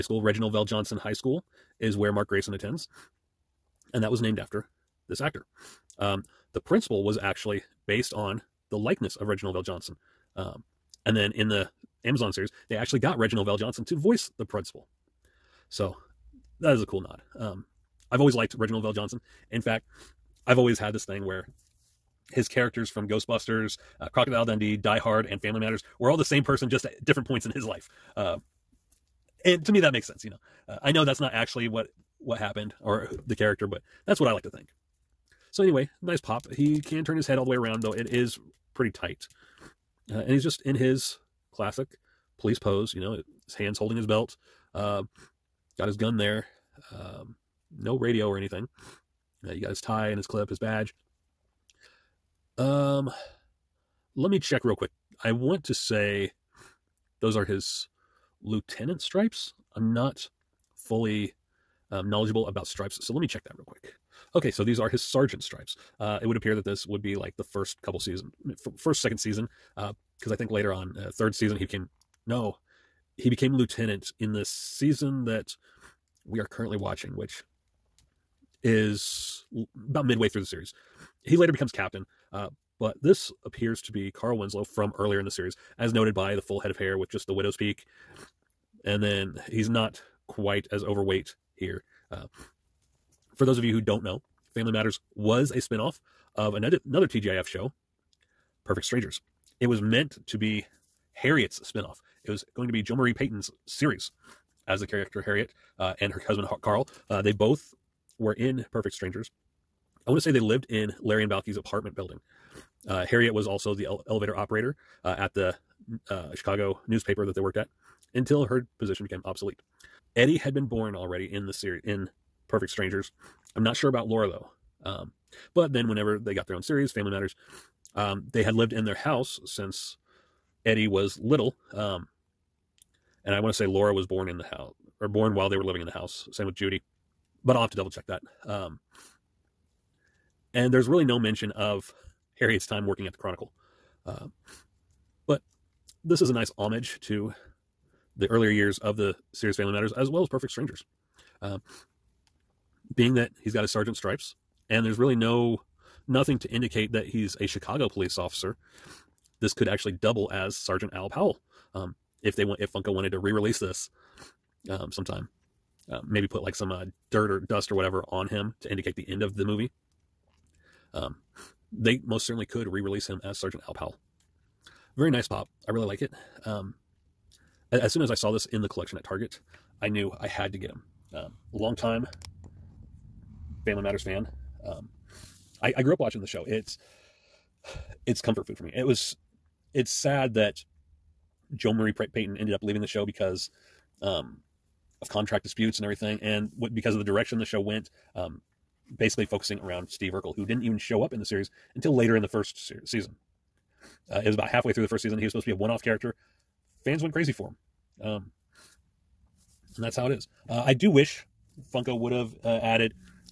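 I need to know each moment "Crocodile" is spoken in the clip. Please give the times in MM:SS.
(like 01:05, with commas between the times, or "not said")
00:24.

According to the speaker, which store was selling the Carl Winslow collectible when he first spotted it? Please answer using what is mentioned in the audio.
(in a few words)
Target.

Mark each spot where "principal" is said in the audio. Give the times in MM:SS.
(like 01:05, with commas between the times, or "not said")
00:06, 00:14.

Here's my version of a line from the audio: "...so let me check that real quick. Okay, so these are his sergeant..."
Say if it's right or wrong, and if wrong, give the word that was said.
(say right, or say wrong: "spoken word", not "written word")
right.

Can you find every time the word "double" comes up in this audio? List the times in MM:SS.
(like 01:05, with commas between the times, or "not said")
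02:17, 02:39.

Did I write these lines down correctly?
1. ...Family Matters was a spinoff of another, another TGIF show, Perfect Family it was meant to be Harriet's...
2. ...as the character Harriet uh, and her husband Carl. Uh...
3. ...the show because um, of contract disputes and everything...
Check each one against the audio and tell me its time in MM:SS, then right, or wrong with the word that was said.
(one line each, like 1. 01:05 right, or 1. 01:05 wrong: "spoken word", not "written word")
1. 01:34 wrong: "Strangers", not "Family"
2. 01:44 right
3. 03:12 right.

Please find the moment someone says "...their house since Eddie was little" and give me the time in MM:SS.
02:08.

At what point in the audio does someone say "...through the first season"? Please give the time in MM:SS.
03:24.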